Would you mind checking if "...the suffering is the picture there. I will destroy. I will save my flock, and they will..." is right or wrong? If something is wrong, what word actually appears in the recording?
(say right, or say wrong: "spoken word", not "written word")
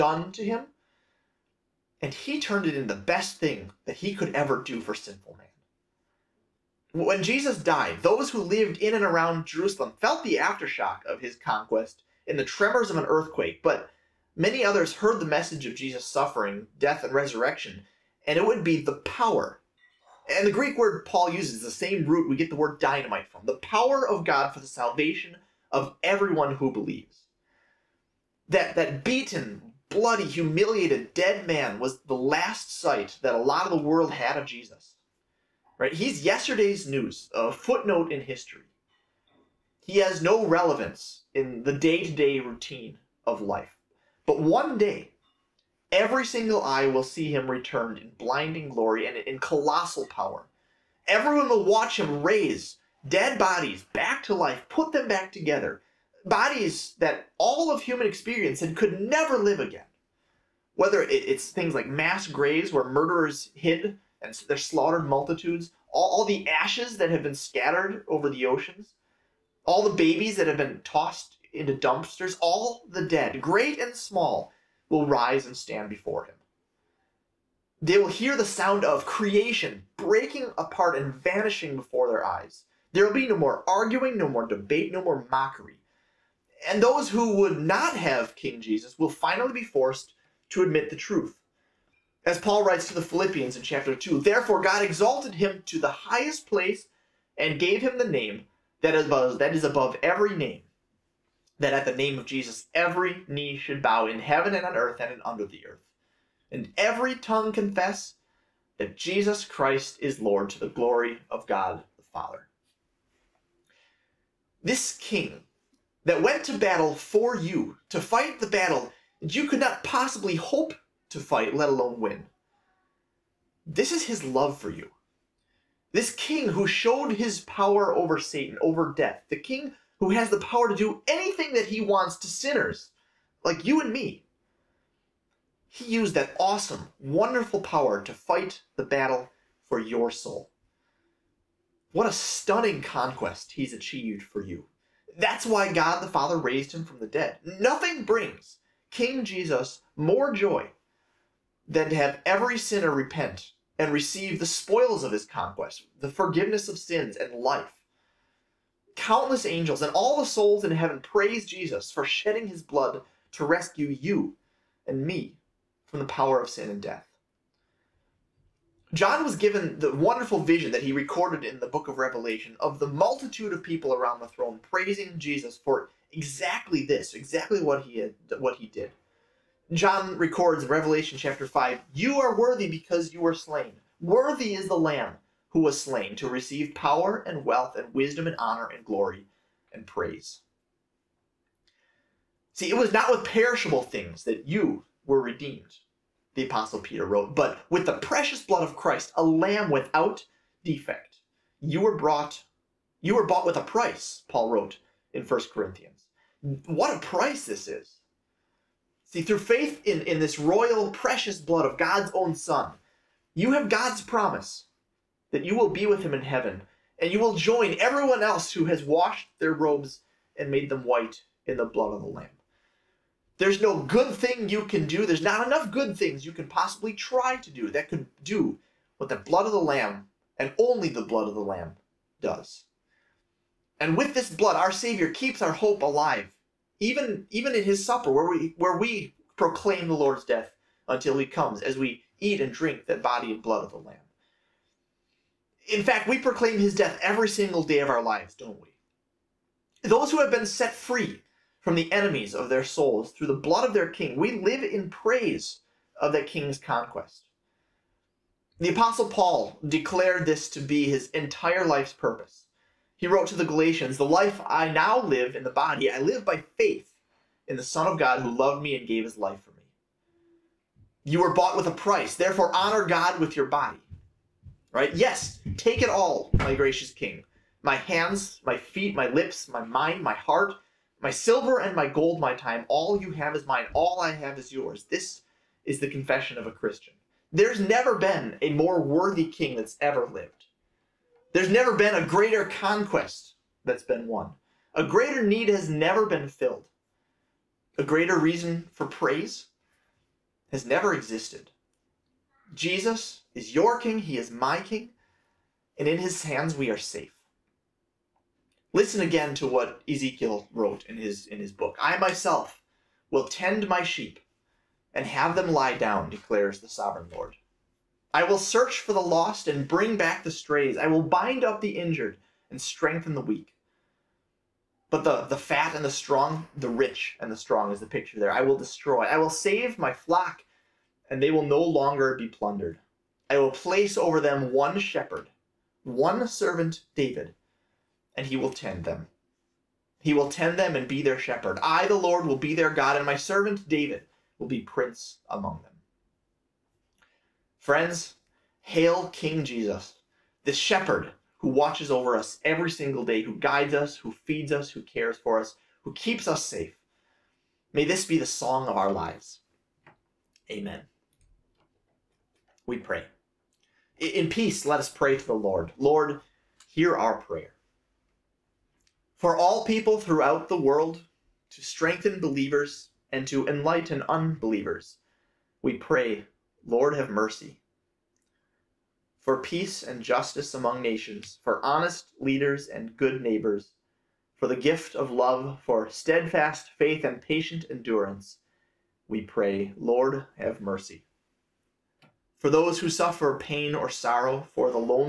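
wrong: "strong", not "suffering".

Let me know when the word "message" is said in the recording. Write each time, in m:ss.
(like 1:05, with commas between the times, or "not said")
0:15.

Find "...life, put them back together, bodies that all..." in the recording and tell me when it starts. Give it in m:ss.
0:54.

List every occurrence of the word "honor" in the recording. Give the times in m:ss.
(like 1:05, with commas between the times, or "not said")
3:08, 4:32.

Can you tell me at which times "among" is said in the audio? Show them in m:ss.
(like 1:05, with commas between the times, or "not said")
5:45, 6:20.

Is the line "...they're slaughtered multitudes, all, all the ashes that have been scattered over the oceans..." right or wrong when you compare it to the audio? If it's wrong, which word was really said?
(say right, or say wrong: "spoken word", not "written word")
right.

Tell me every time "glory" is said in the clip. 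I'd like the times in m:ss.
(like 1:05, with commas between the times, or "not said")
0:48, 1:50, 3:08.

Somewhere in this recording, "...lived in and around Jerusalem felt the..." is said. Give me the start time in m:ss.
0:08.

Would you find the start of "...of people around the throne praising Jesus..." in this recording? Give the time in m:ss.
2:53.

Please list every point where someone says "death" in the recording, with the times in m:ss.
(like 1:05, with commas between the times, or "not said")
0:16, 2:08, 2:46, 4:00, 4:06.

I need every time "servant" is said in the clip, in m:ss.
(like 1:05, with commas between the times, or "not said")
5:36, 5:43.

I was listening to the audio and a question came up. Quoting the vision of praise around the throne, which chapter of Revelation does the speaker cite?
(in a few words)
Chapter 5.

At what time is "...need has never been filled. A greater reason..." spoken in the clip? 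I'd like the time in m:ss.
4:55.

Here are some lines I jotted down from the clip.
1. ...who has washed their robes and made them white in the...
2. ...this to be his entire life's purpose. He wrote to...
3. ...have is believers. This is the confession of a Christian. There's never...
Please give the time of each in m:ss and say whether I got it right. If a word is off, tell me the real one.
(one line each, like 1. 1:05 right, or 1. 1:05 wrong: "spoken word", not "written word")
1. 3:38 right
2. 4:20 right
3. 4:44 wrong: "yours", not "believers".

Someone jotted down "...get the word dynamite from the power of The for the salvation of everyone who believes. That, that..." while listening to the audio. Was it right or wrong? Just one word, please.
wrong.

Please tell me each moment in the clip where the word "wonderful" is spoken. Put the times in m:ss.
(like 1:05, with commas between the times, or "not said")
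2:16, 2:49.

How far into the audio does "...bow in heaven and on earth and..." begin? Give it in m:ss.
1:43.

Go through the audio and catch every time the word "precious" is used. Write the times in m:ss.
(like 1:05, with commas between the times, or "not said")
3:17, 3:30.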